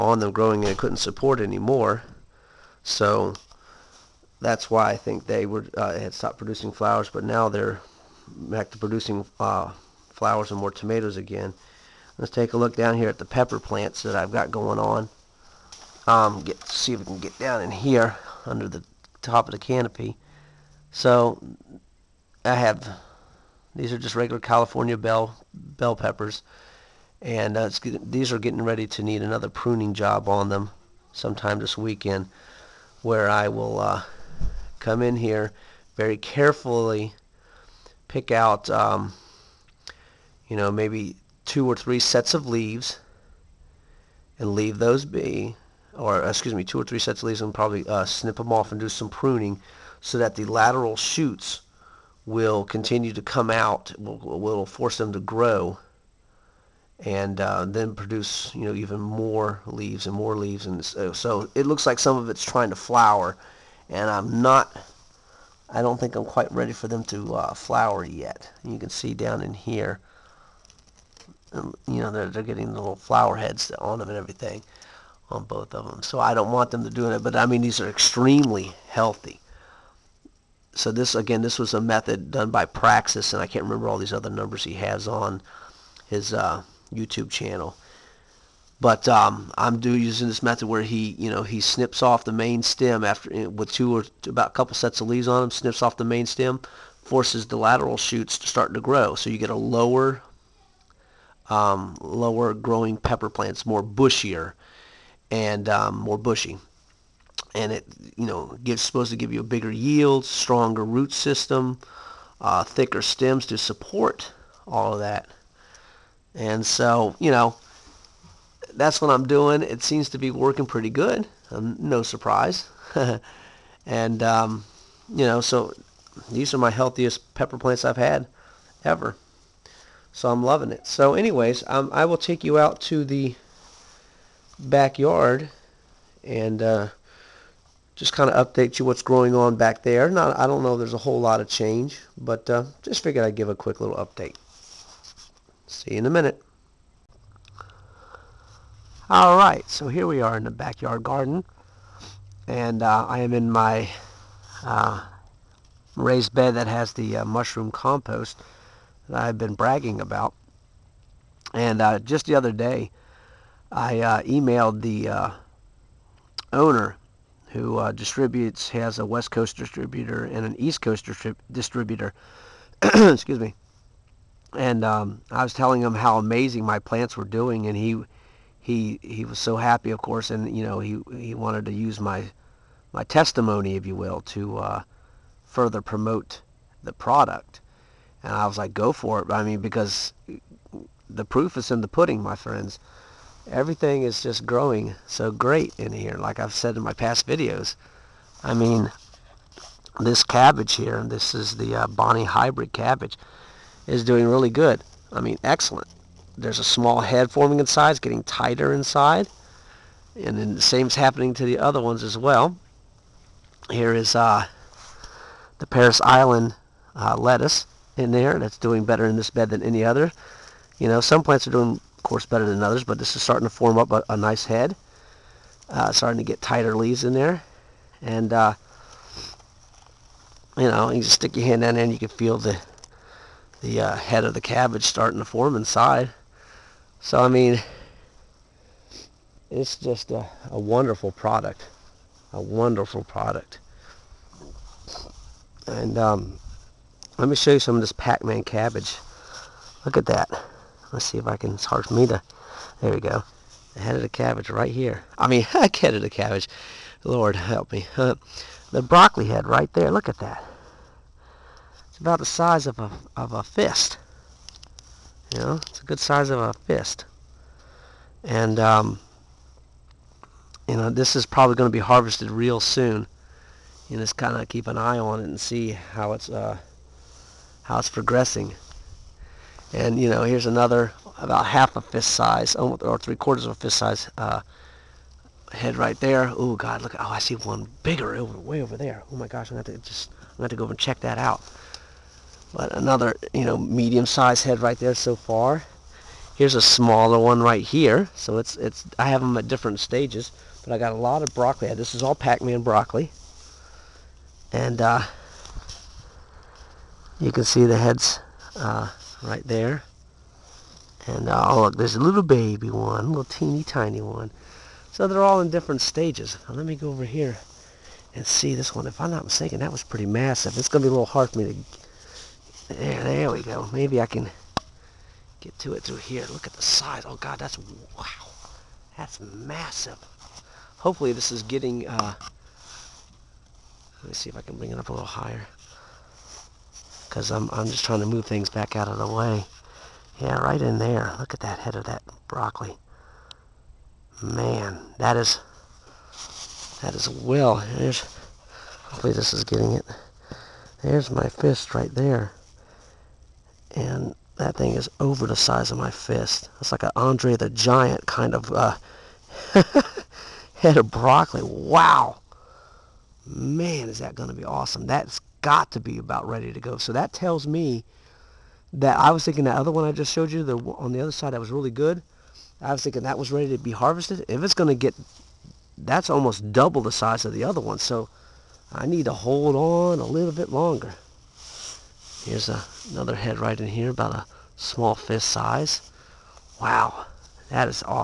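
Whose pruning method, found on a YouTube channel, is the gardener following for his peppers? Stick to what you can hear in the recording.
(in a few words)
Praxxus.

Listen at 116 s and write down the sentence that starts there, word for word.
And so you know that's what I'm doing.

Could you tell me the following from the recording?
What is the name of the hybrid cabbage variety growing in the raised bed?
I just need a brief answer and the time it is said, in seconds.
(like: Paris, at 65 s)
Bonnie, at 201 s.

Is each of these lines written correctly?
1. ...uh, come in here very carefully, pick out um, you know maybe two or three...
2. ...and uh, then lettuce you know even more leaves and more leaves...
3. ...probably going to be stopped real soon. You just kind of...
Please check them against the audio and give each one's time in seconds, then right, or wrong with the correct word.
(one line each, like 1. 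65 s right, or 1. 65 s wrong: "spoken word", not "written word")
1. 33 s right
2. 57 s wrong: "produce", not "lettuce"
3. 271 s wrong: "harvested", not "stopped".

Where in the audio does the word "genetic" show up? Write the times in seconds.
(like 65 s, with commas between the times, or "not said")
not said.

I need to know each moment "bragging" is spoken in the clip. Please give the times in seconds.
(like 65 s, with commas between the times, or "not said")
159 s.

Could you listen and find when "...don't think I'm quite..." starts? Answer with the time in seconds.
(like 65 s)
65 s.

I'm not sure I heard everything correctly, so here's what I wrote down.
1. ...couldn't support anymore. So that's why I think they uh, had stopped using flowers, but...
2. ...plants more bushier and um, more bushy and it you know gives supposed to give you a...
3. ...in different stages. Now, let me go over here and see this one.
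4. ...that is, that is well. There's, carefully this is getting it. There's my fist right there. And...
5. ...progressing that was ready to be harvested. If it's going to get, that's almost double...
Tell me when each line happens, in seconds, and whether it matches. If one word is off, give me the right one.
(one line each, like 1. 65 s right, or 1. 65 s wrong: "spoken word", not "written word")
1. 0 s wrong: "producing", not "using"
2. 103 s right
3. 315 s right
4. 344 s wrong: "hopefully", not "carefully"
5. 372 s wrong: "thinking", not "progressing".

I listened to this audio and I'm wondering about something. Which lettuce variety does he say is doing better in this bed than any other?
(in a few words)
Parris Island.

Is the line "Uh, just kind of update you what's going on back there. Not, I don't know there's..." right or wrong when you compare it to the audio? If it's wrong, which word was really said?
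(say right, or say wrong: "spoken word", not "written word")
right.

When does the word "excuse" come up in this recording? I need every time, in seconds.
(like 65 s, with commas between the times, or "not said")
46 s, 172 s.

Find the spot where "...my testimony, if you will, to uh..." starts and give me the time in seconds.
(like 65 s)
182 s.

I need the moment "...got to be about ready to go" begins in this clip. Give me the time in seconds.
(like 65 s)
365 s.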